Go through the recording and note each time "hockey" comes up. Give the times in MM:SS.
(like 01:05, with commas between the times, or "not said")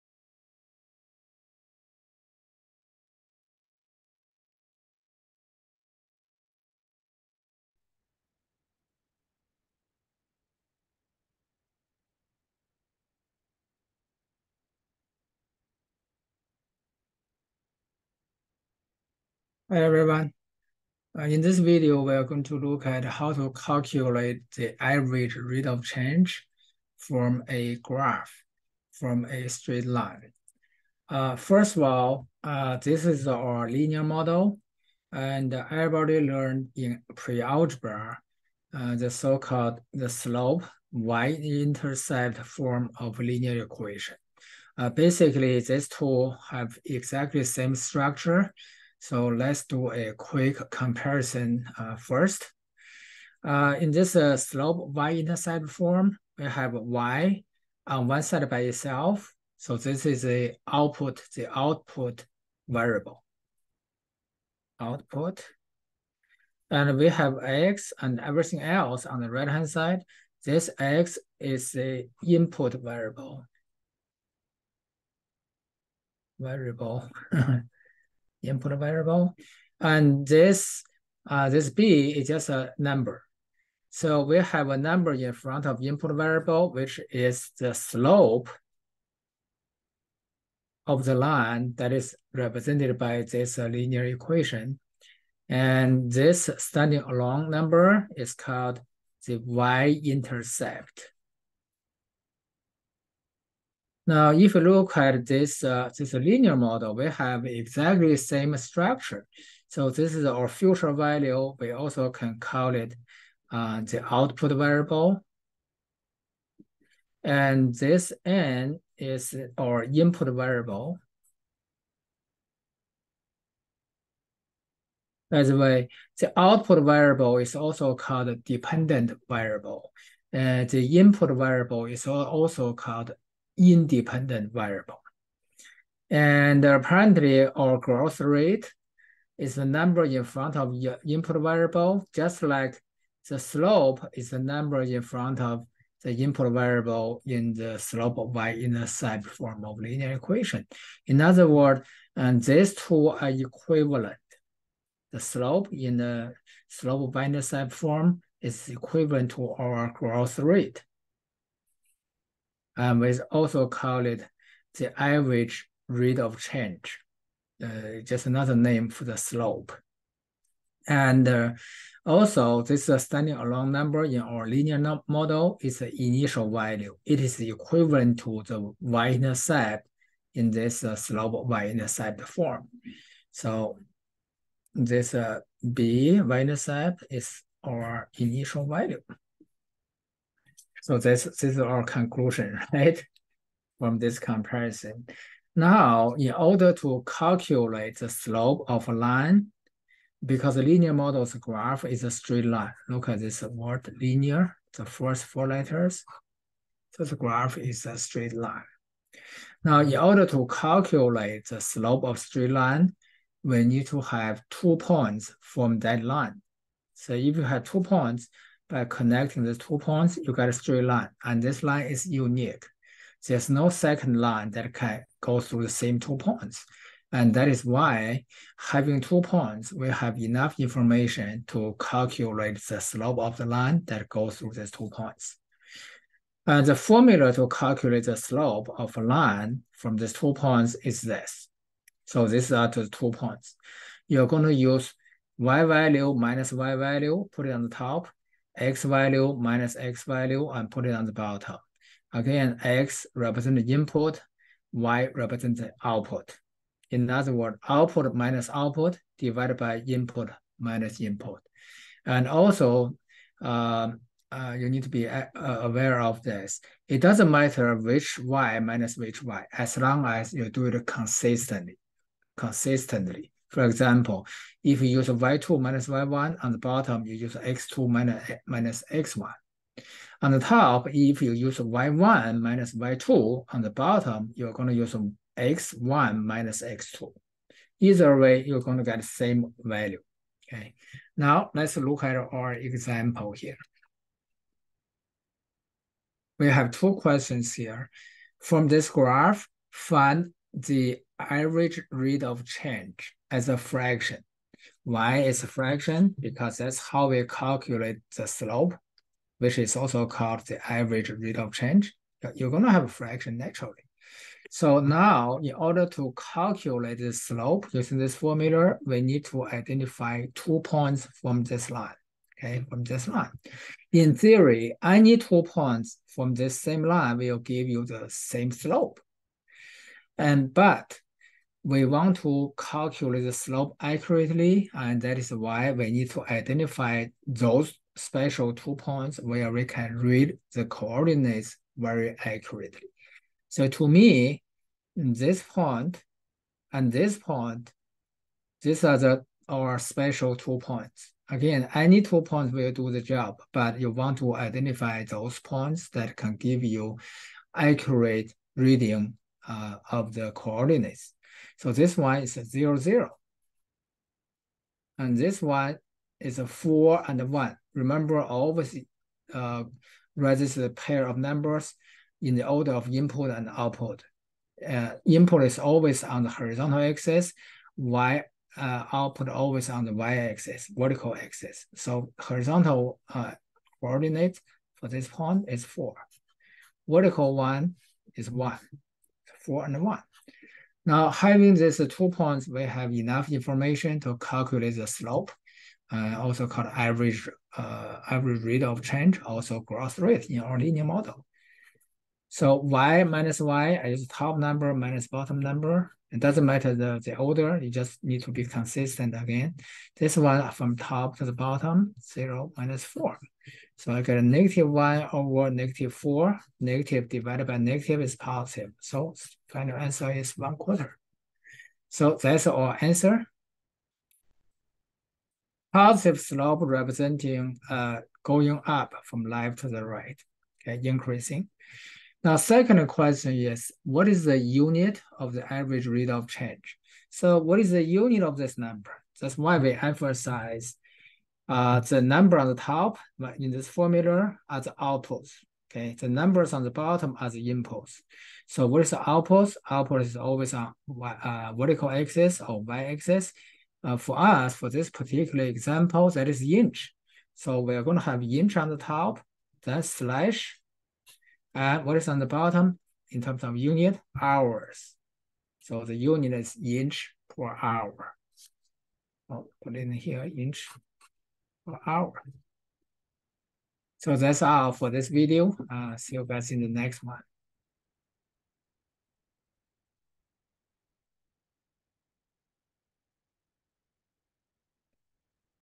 not said.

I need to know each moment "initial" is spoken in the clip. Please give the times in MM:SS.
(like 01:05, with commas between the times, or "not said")
02:56, 03:08.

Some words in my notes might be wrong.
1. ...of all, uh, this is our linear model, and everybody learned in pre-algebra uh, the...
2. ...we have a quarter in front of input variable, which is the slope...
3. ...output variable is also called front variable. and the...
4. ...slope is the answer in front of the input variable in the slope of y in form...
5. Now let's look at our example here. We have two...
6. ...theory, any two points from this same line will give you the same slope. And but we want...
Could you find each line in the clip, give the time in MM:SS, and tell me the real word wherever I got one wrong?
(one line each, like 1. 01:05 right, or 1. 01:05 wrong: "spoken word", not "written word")
1. 00:31 right
2. 01:24 wrong: "number", not "quarter"
3. 02:06 wrong: "dependent", not "front"
4. 02:23 wrong: "number", not "answer"
5. 04:51 right
6. 05:24 right.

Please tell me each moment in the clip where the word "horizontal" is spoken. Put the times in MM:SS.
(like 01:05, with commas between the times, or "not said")
06:16, 06:22.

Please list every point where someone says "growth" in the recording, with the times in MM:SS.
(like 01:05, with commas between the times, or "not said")
02:17, 02:39, 06:39.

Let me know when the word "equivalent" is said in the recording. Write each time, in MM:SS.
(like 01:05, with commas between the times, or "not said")
02:33, 02:38, 02:57.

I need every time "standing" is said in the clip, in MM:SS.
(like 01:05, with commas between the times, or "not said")
01:36, 02:52.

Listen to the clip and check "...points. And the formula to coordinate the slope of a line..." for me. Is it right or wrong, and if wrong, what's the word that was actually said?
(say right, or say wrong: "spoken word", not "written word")
wrong: "calculate", not "coordinate".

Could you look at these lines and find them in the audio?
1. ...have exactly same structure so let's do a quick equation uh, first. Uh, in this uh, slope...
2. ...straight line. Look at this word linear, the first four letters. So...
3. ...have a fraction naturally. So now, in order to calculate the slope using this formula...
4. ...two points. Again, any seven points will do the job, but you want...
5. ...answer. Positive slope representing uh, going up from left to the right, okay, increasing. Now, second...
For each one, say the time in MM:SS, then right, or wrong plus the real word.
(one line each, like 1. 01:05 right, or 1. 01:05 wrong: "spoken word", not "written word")
1. 00:46 wrong: "comparison", not "equation"
2. 03:22 right
3. 05:12 right
4. 05:50 wrong: "two", not "seven"
5. 07:02 right.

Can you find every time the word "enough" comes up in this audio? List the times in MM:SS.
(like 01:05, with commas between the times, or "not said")
03:50, 06:32.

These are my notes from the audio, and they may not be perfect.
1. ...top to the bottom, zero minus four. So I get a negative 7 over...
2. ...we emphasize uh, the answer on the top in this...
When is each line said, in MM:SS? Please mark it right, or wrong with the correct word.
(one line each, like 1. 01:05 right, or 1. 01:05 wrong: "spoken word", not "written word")
1. 06:50 wrong: "1", not "7"
2. 07:19 wrong: "number", not "answer".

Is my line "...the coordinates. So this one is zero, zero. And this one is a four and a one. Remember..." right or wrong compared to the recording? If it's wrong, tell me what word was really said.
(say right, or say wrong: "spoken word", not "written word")
right.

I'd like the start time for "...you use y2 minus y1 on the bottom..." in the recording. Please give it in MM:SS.
04:34.